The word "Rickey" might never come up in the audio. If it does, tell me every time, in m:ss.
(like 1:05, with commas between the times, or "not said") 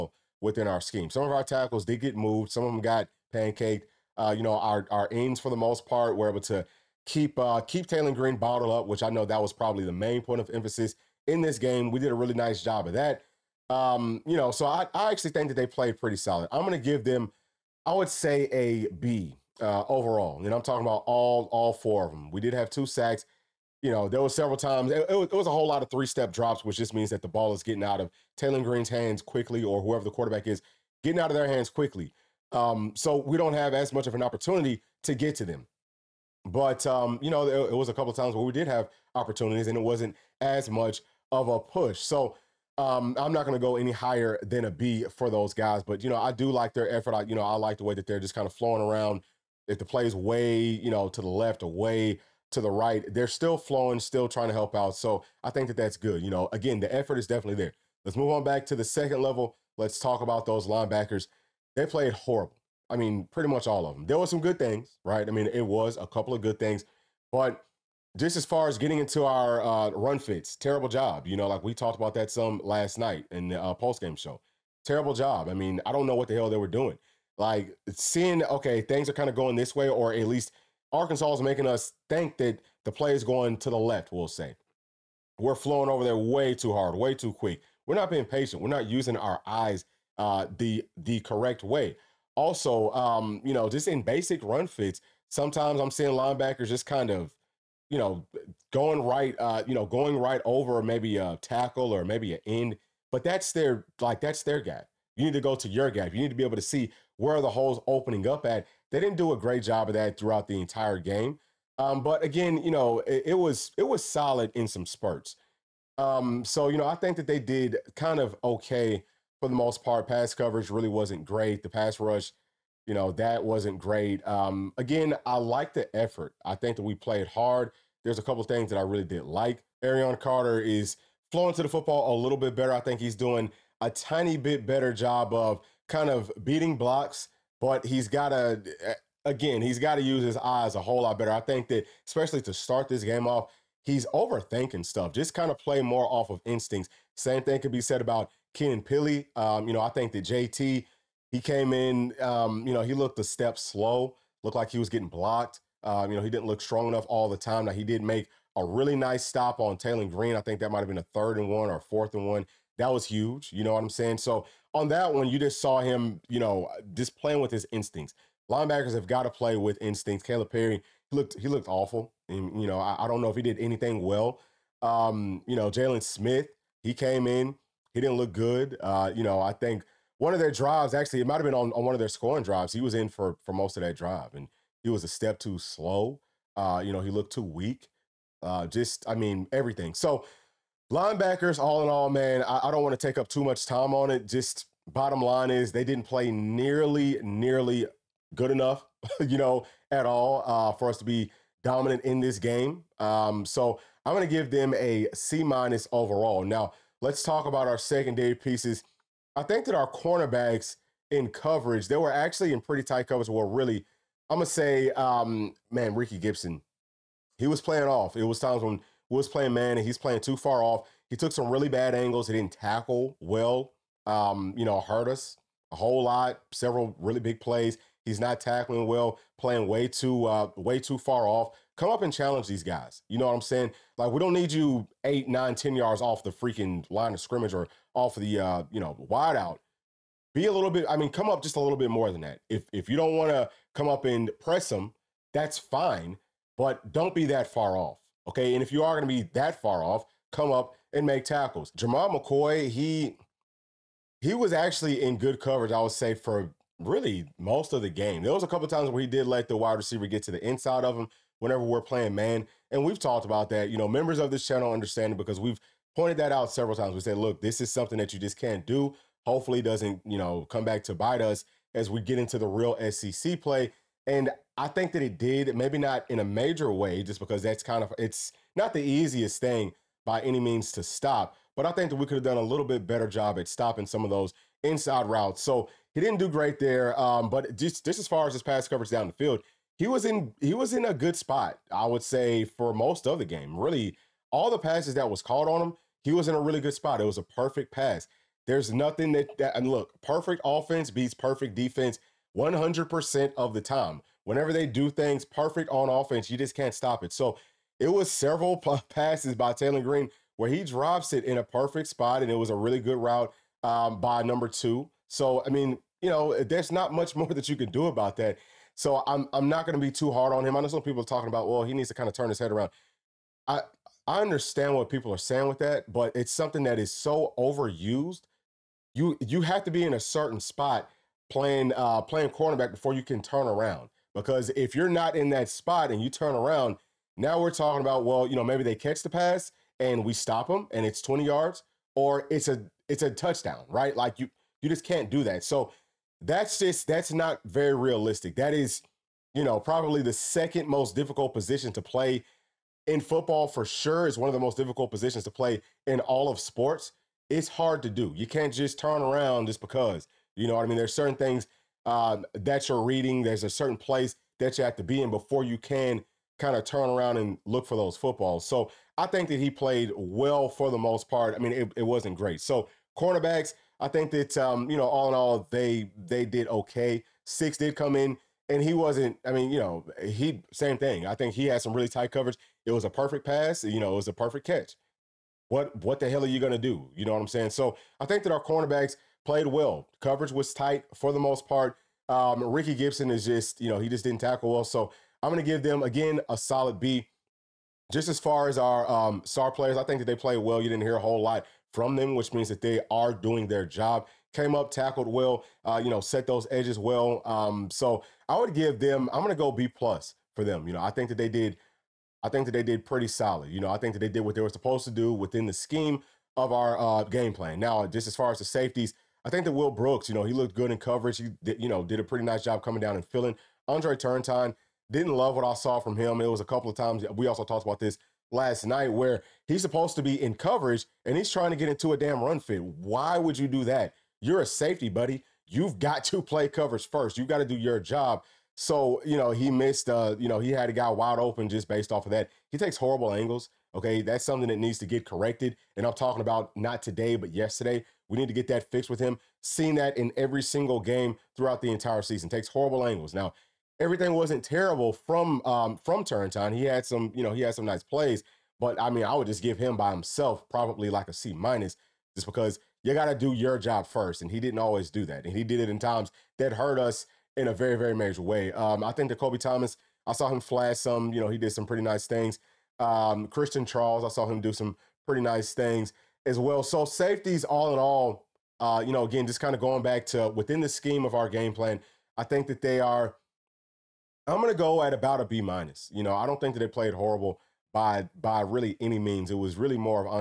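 3:35, 6:32.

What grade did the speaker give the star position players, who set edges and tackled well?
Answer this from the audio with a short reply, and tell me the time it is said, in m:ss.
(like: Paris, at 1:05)
B plus, at 6:49.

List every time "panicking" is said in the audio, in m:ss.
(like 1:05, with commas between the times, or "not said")
not said.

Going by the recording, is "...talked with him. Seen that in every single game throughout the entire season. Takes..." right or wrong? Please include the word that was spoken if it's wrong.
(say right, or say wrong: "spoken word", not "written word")
wrong: "fixed", not "talked".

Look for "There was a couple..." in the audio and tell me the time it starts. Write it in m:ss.
4:18.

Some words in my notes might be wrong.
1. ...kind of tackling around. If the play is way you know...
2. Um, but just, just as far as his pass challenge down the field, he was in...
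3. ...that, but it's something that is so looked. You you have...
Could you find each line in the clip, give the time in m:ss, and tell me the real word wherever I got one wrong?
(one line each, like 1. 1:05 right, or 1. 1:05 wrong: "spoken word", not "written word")
1. 0:48 wrong: "flowing", not "tackling"
2. 4:46 wrong: "coverage", not "challenge"
3. 5:25 wrong: "overused", not "looked".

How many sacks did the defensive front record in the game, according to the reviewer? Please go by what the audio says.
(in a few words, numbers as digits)
2.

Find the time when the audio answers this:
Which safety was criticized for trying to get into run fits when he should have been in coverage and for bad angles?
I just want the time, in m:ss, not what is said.
7:03.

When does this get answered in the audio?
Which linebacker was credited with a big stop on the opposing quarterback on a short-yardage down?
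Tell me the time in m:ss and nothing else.
2:30.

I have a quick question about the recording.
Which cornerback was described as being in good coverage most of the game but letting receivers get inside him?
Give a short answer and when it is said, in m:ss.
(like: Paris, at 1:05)
Jermod McCoy, at 4:11.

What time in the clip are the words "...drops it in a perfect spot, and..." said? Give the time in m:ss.
5:10.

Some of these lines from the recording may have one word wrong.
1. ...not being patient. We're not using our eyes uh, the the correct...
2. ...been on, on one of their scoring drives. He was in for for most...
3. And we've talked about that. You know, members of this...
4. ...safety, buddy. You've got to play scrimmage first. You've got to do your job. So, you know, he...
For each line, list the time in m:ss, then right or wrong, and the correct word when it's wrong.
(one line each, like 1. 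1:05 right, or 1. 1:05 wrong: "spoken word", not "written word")
1. 1:27 right
2. 3:01 right
3. 4:22 right
4. 7:14 wrong: "coverage", not "scrimmage".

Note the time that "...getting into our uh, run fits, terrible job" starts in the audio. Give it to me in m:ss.
1:08.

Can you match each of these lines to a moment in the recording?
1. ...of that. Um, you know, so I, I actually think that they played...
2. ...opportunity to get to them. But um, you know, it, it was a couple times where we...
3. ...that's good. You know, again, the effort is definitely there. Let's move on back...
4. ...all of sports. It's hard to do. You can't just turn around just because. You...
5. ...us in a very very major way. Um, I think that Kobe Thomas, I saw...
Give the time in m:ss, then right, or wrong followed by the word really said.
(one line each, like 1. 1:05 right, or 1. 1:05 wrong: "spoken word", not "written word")
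1. 0:12 right
2. 0:34 right
3. 0:55 right
4. 5:55 right
5. 7:46 right.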